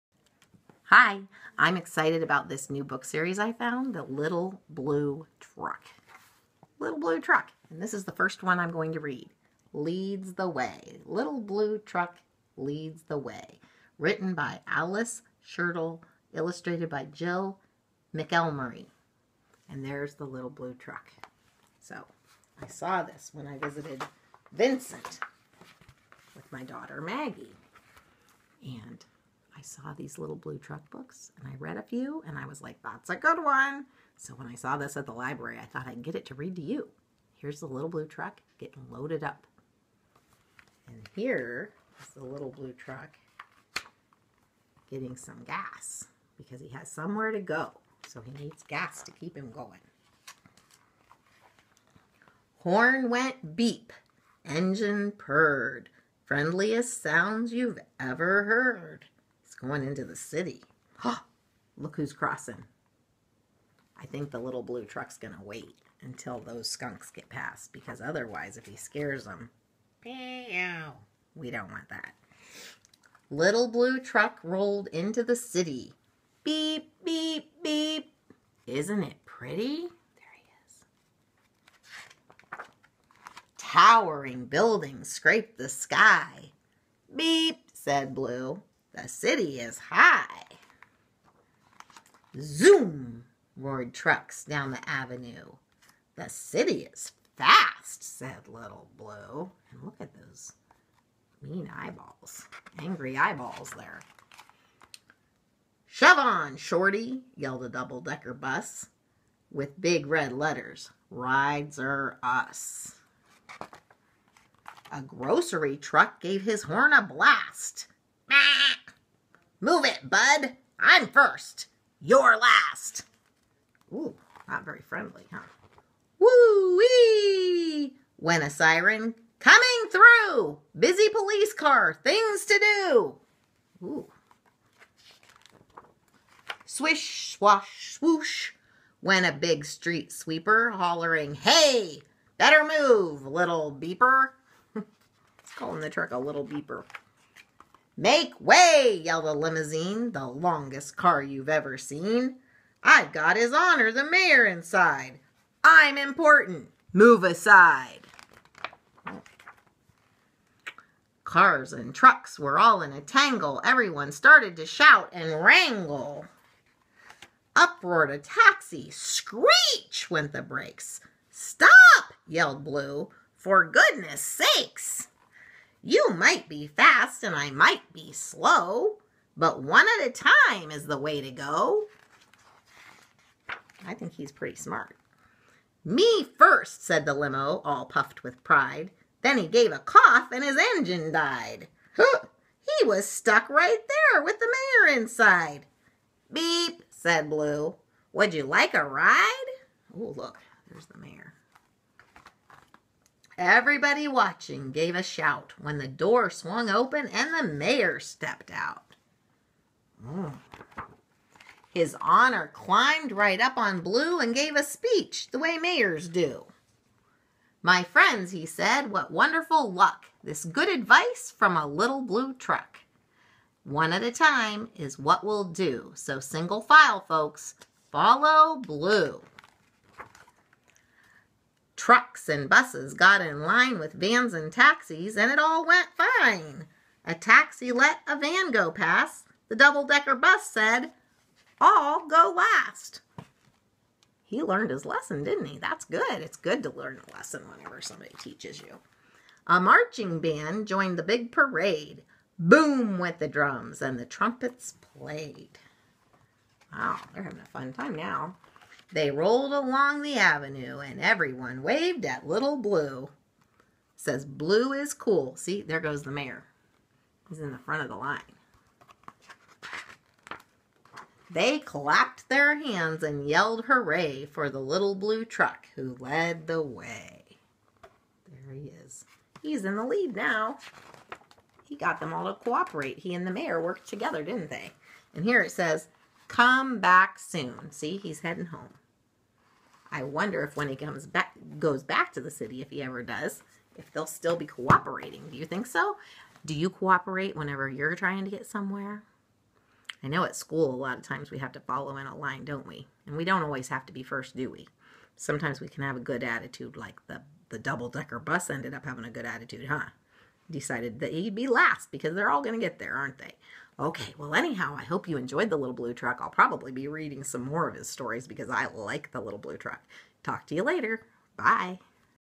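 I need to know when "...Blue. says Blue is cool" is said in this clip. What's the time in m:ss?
4:22.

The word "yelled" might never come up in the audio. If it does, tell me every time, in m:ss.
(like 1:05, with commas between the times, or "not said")
1:47, 2:29, 2:52, 4:33.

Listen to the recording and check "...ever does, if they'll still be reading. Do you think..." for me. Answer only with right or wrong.
wrong.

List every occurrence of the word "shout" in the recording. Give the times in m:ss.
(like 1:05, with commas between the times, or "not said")
2:44, 3:25.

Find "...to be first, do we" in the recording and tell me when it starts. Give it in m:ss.
5:03.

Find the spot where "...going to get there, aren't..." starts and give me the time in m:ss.
5:12.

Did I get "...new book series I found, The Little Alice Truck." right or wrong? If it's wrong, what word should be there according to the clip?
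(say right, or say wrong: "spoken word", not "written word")
wrong: "Blue", not "Alice".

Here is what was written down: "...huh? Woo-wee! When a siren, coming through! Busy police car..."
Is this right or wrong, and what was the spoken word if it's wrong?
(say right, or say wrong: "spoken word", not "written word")
right.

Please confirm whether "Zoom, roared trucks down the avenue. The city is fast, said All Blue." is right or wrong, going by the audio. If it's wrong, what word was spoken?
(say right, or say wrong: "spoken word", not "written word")
wrong: "Little", not "All".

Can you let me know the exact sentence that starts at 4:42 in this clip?
He and the mayor worked together, didn't they?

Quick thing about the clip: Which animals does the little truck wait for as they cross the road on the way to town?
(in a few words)
Skunks.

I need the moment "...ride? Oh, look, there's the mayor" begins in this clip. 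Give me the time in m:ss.
3:18.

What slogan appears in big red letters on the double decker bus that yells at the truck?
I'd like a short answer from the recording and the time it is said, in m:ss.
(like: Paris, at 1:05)
Rides are us, at 1:51.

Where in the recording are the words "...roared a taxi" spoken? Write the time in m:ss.
2:47.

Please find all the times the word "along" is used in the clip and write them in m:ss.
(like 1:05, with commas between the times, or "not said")
4:19.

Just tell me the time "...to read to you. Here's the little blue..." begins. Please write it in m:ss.
0:36.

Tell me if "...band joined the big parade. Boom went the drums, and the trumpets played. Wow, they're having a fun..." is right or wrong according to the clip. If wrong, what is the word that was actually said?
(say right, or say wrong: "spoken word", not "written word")
right.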